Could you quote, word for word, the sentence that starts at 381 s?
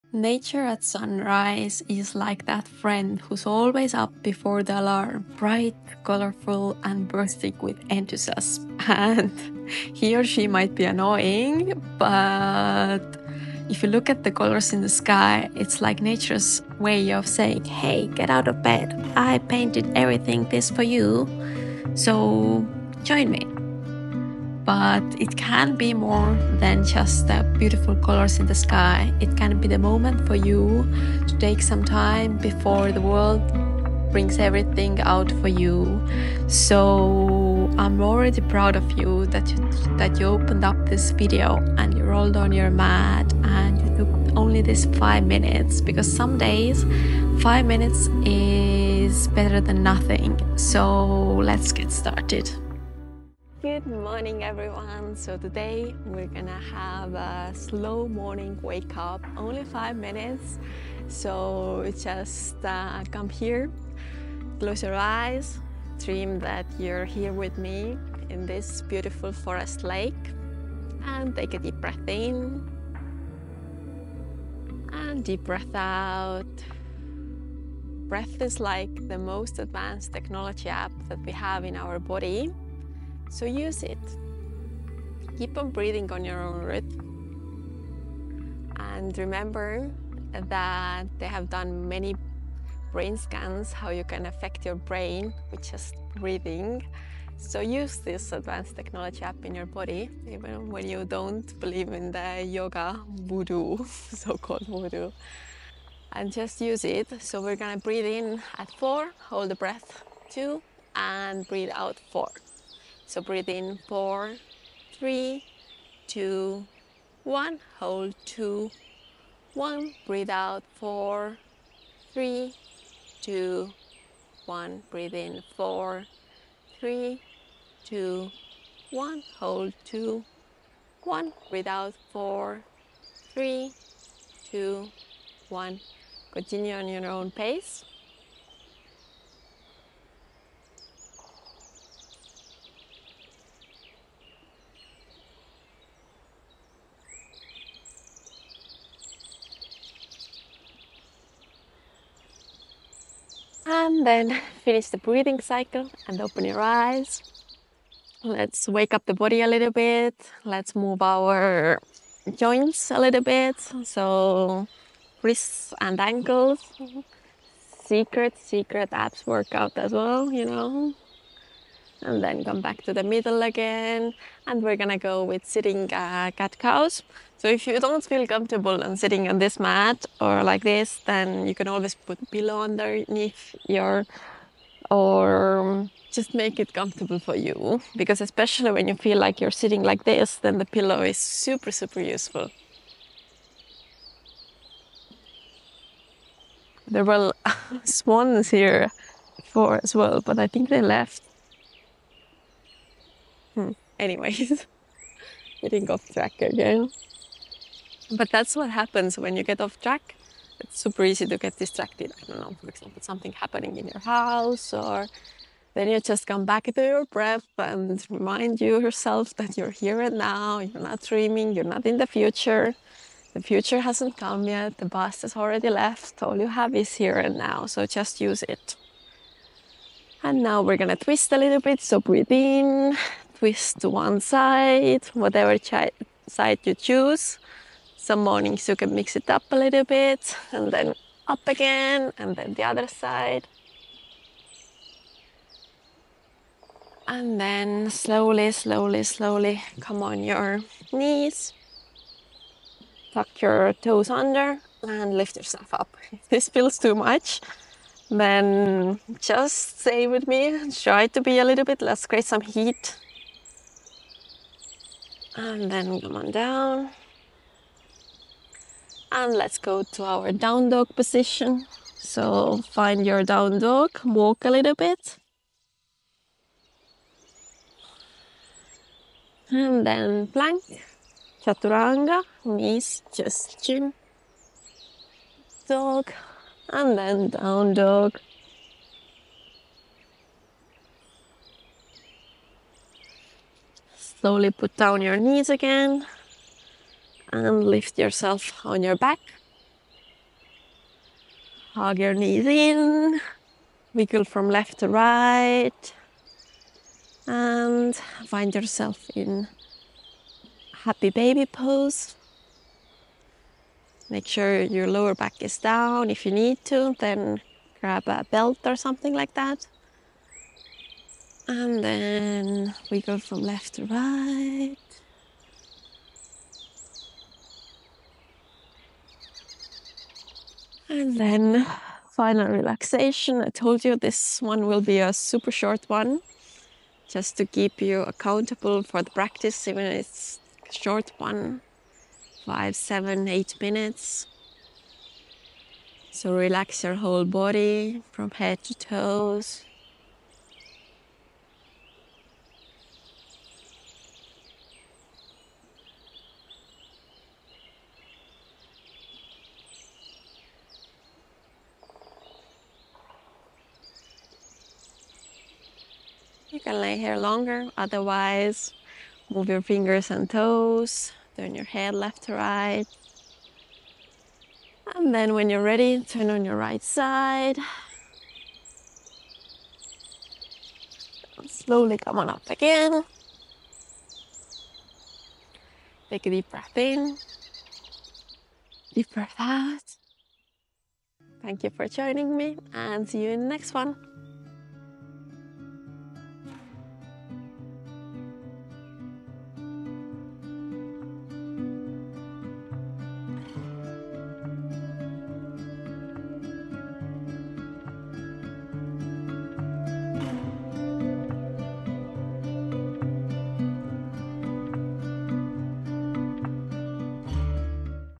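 And slowly come on up again.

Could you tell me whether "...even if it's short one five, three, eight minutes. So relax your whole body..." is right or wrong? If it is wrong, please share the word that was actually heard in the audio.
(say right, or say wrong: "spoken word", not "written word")
wrong: "seven", not "three".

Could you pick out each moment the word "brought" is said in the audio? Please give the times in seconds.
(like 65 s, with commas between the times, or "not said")
not said.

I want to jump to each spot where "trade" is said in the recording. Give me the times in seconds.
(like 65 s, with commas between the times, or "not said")
not said.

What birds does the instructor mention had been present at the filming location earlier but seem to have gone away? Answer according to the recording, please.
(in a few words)
Swans.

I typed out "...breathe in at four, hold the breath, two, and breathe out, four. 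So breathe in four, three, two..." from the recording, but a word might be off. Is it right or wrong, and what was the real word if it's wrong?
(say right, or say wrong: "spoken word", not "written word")
right.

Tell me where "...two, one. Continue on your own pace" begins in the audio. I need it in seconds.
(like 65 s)
134 s.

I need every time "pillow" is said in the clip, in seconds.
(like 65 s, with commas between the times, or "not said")
182 s, 190 s.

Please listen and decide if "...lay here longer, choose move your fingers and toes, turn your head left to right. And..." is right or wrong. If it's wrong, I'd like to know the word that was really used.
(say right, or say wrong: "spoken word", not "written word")
wrong: "otherwise", not "choose".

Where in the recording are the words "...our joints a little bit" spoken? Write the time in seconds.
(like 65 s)
161 s.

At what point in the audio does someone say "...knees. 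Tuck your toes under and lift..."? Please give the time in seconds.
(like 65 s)
250 s.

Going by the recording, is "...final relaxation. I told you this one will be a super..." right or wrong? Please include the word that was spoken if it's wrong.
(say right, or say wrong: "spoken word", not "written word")
right.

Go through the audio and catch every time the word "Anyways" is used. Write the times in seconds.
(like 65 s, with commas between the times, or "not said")
203 s.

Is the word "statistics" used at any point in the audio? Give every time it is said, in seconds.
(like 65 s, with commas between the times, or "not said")
not said.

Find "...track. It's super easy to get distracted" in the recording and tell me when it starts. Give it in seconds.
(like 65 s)
209 s.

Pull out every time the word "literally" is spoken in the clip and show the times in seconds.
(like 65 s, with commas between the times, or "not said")
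not said.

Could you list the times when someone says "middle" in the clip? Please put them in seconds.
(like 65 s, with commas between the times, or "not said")
173 s.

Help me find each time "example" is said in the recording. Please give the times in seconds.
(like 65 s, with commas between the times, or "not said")
212 s.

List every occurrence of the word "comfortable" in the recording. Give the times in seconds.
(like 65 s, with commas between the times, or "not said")
178 s, 186 s.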